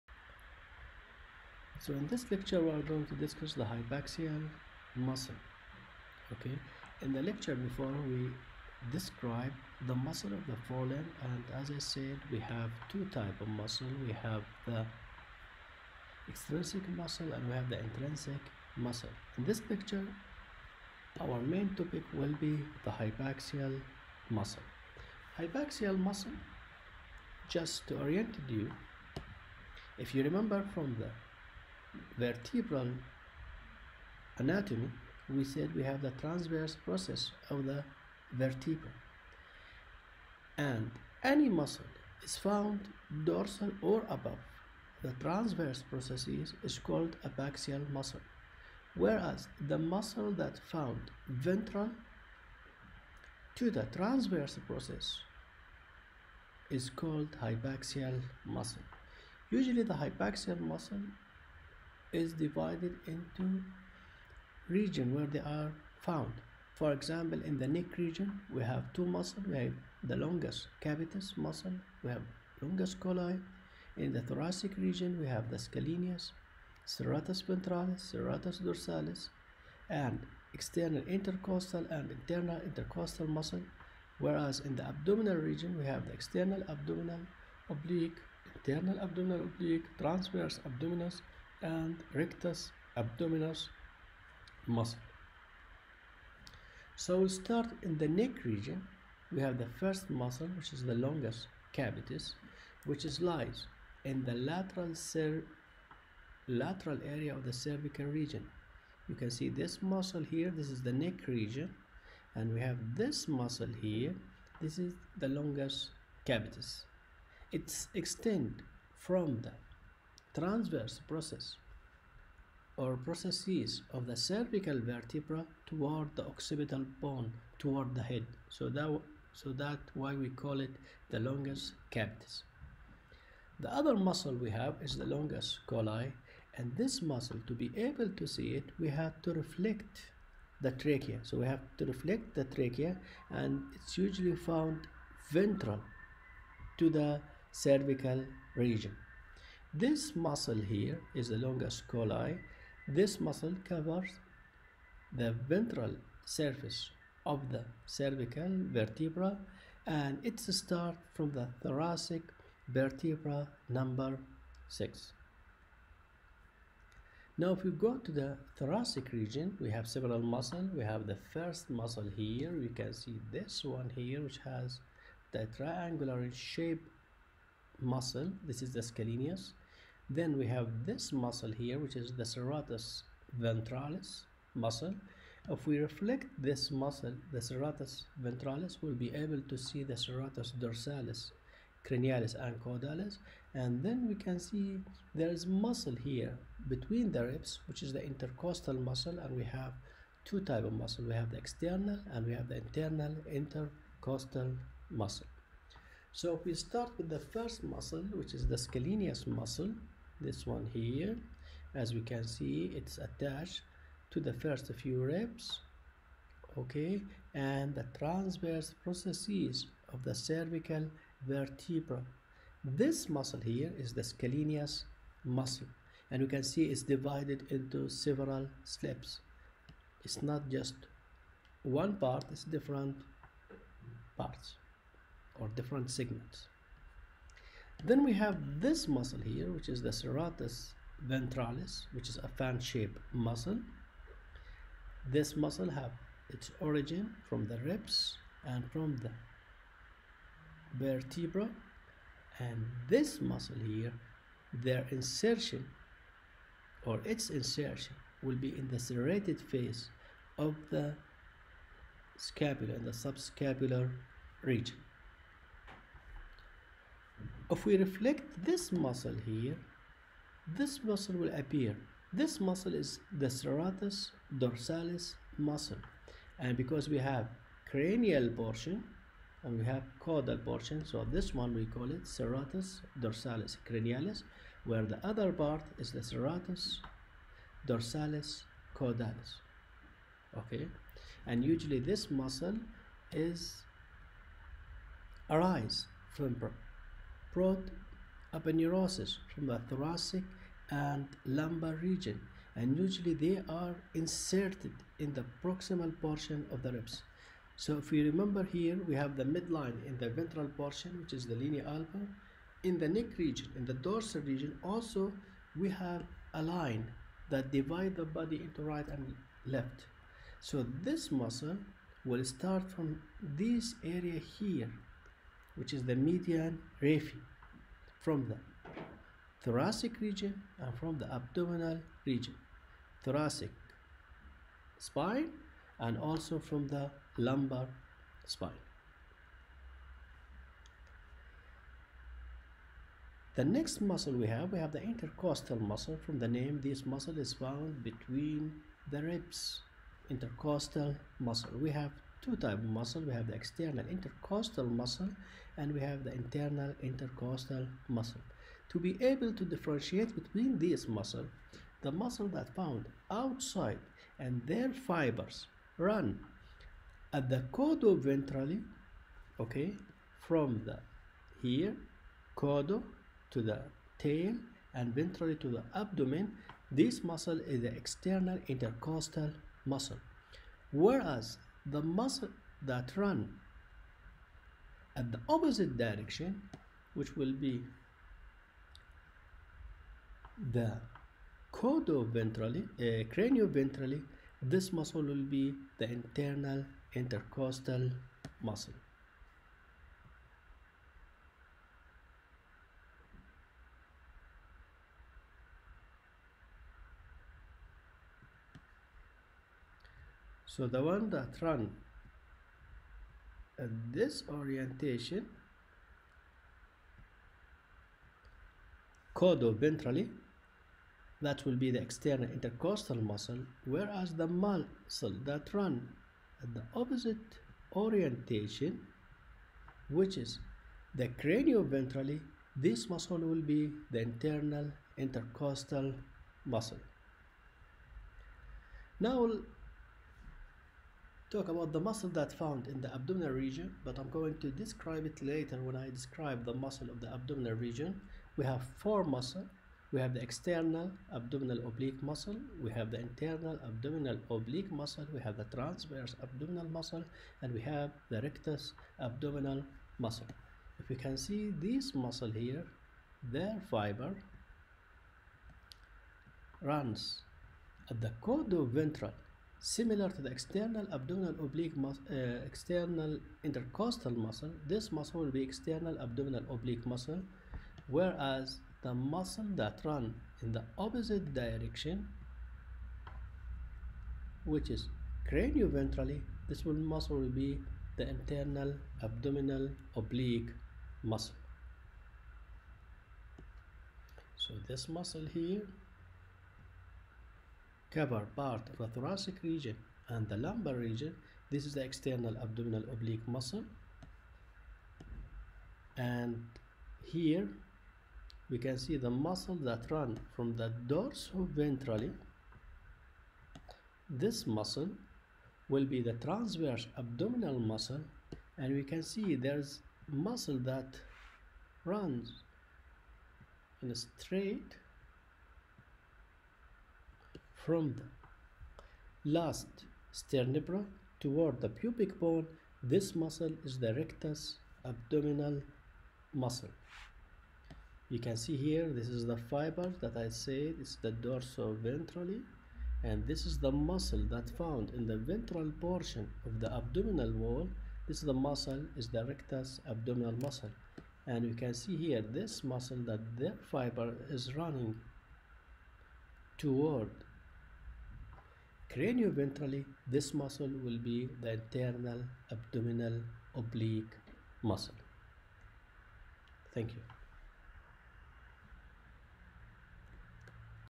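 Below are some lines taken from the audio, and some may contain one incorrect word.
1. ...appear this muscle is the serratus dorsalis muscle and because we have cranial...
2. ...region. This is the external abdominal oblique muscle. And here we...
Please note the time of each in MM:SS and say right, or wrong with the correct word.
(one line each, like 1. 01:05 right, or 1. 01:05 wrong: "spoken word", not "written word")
1. 04:31 right
2. 08:20 right.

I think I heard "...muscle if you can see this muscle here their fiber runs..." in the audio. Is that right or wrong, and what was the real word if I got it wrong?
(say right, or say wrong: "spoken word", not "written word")
right.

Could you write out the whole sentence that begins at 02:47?
Now if we go to the thoracic region, we have several muscles.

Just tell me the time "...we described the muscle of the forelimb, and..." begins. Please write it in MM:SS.
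00:08.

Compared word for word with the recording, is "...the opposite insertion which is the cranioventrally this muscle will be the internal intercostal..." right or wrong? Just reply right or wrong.
wrong.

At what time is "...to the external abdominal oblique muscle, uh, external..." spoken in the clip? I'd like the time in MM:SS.
07:50.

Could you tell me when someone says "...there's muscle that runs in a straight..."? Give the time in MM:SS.
08:39.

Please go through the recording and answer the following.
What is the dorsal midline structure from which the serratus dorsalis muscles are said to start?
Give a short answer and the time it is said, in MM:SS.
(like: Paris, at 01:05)
median raphe, at 05:25.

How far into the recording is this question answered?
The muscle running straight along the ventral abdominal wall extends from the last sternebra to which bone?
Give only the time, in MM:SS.
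08:51.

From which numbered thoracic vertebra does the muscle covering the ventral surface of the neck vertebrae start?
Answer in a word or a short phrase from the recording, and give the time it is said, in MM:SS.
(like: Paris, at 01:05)
6, at 02:43.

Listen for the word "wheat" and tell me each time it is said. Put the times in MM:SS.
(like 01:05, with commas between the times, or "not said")
not said.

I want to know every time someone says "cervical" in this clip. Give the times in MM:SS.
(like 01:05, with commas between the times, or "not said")
01:47, 02:04, 02:27, 02:37, 03:40.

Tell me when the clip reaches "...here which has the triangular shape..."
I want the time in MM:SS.
02:53.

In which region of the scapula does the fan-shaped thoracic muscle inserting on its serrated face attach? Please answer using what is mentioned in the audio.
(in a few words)
subscapular region.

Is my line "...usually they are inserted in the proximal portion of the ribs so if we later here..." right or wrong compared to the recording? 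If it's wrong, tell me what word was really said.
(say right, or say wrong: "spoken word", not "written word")
wrong: "remember", not "later".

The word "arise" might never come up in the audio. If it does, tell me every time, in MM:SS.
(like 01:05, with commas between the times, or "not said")
04:55.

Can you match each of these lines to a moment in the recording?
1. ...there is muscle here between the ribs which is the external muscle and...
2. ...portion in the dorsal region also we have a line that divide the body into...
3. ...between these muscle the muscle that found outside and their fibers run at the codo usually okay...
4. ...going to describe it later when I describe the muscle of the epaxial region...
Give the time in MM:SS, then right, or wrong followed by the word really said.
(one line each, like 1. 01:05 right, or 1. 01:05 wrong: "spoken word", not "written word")
1. 03:15 wrong: "intercostal", not "external"
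2. 05:13 wrong: "region", not "portion"
3. 06:00 wrong: "ventrally", not "usually"
4. 07:24 wrong: "abdominal", not "epaxial".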